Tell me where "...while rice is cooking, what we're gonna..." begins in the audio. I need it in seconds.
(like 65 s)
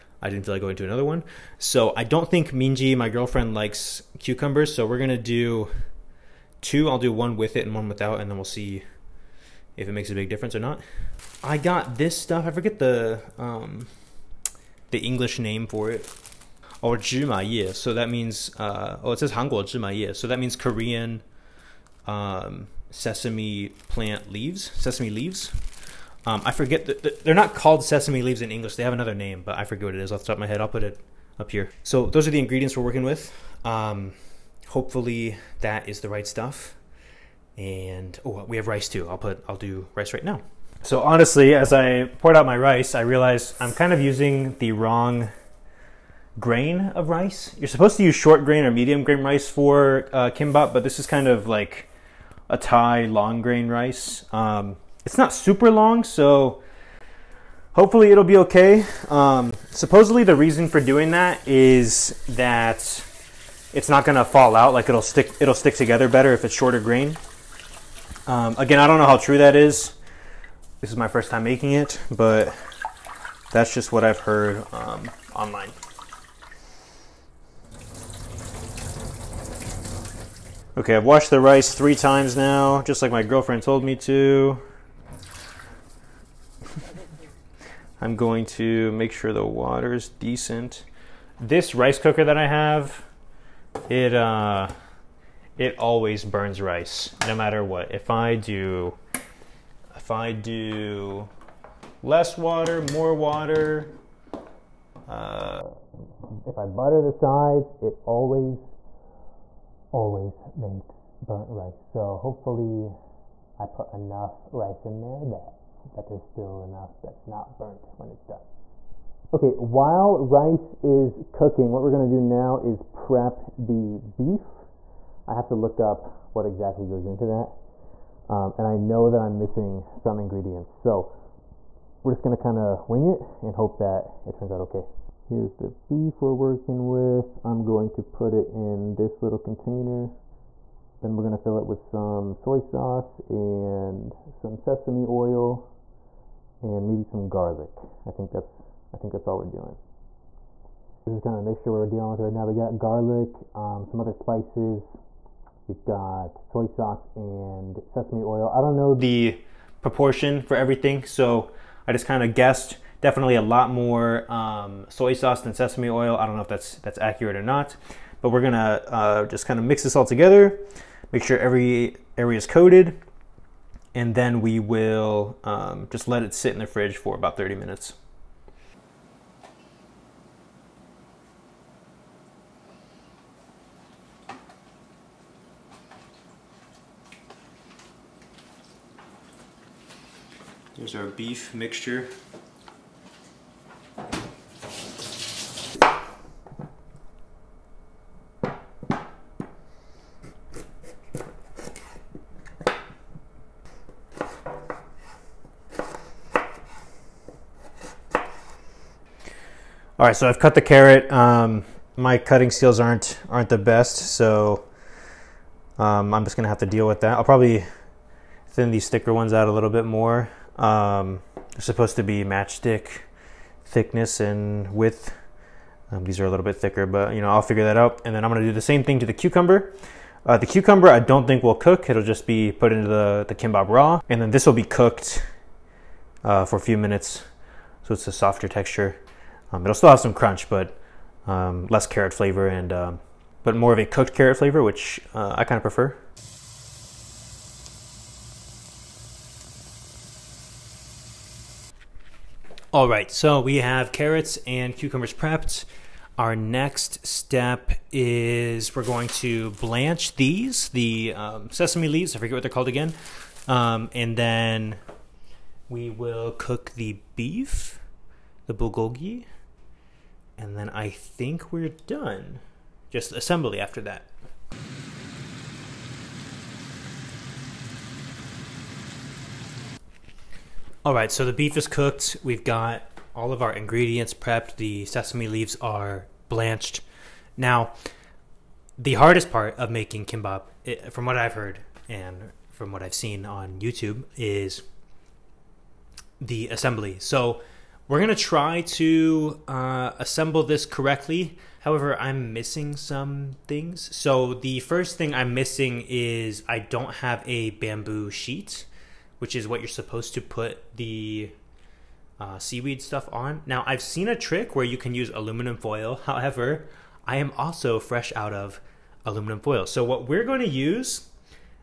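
119 s.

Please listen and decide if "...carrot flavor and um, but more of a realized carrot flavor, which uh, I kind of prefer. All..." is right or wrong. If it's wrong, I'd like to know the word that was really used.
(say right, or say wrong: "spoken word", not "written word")
wrong: "cooked", not "realized".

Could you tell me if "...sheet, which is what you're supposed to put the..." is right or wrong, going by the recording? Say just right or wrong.
right.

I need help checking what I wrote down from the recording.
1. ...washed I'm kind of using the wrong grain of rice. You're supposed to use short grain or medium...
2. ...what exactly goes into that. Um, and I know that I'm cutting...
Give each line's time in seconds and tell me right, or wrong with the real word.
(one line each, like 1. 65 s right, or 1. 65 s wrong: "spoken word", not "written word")
1. 43 s wrong: "realized", not "washed"
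2. 126 s wrong: "missing", not "cutting".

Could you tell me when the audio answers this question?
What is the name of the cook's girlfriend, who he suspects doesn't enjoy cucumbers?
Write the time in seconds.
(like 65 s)
2 s.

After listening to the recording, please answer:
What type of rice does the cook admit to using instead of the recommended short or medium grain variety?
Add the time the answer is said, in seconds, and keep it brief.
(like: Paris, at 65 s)
Thai long grain rice, at 52 s.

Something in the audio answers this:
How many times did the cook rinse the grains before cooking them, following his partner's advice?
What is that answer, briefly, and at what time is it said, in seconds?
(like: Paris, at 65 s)
3, at 81 s.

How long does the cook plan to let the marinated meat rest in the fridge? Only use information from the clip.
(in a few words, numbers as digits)
30 minutes.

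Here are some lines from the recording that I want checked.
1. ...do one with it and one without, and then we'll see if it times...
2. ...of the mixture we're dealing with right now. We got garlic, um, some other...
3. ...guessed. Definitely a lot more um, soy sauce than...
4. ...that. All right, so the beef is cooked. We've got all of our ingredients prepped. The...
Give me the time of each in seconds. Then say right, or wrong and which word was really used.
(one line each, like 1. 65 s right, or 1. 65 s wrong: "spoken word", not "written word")
1. 6 s wrong: "makes", not "times"
2. 151 s right
3. 162 s right
4. 273 s right.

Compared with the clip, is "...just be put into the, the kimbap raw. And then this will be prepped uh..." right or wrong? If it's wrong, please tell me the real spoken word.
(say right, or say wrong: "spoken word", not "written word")
wrong: "cooked", not "prepped".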